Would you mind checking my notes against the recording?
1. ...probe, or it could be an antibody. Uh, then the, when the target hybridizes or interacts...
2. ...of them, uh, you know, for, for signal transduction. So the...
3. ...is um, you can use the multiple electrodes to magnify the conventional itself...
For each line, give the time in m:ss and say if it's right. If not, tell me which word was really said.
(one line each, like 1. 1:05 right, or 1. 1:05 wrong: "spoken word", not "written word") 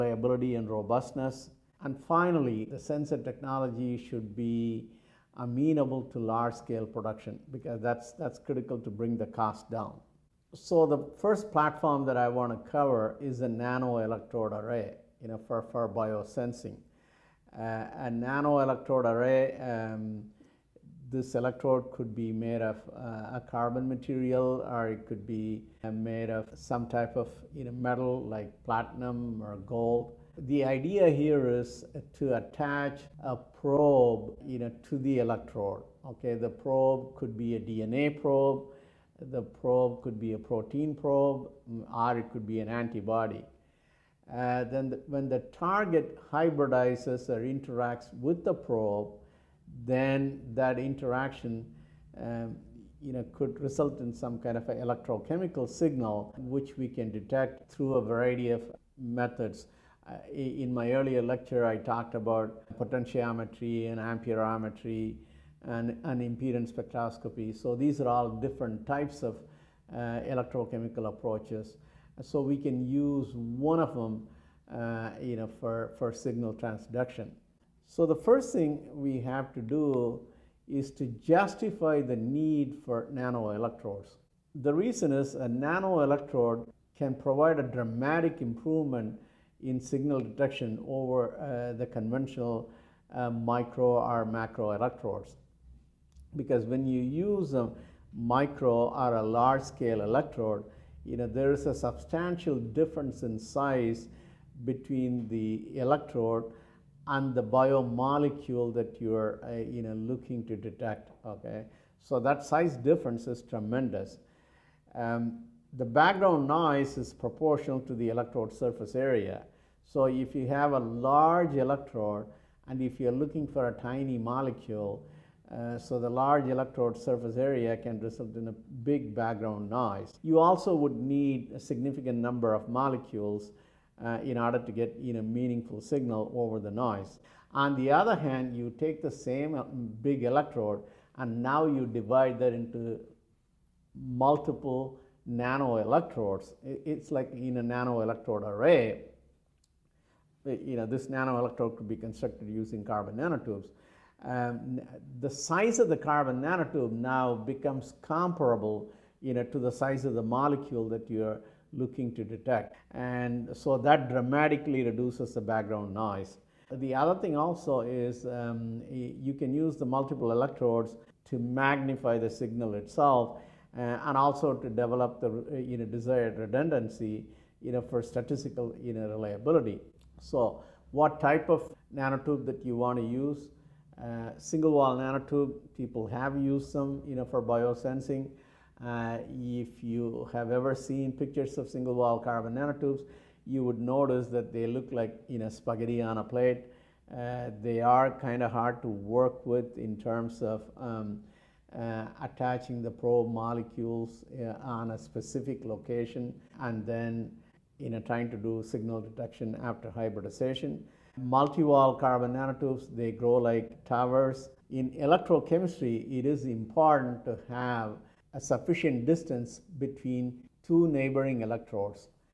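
1. 0:40 right
2. 1:13 right
3. 2:47 wrong: "signal", not "conventional".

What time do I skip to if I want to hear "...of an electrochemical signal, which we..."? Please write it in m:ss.
0:54.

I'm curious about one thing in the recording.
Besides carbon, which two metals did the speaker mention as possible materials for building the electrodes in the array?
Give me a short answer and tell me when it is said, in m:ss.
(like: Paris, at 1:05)
platinum or gold, at 0:28.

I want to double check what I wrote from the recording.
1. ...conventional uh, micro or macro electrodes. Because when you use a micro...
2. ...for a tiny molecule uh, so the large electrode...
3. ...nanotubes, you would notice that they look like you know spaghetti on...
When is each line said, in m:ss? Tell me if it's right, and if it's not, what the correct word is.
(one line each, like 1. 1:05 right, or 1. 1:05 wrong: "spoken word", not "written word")
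1. 1:31 right
2. 2:03 right
3. 3:12 right.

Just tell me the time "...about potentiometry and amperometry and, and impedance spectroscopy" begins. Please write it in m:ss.
1:02.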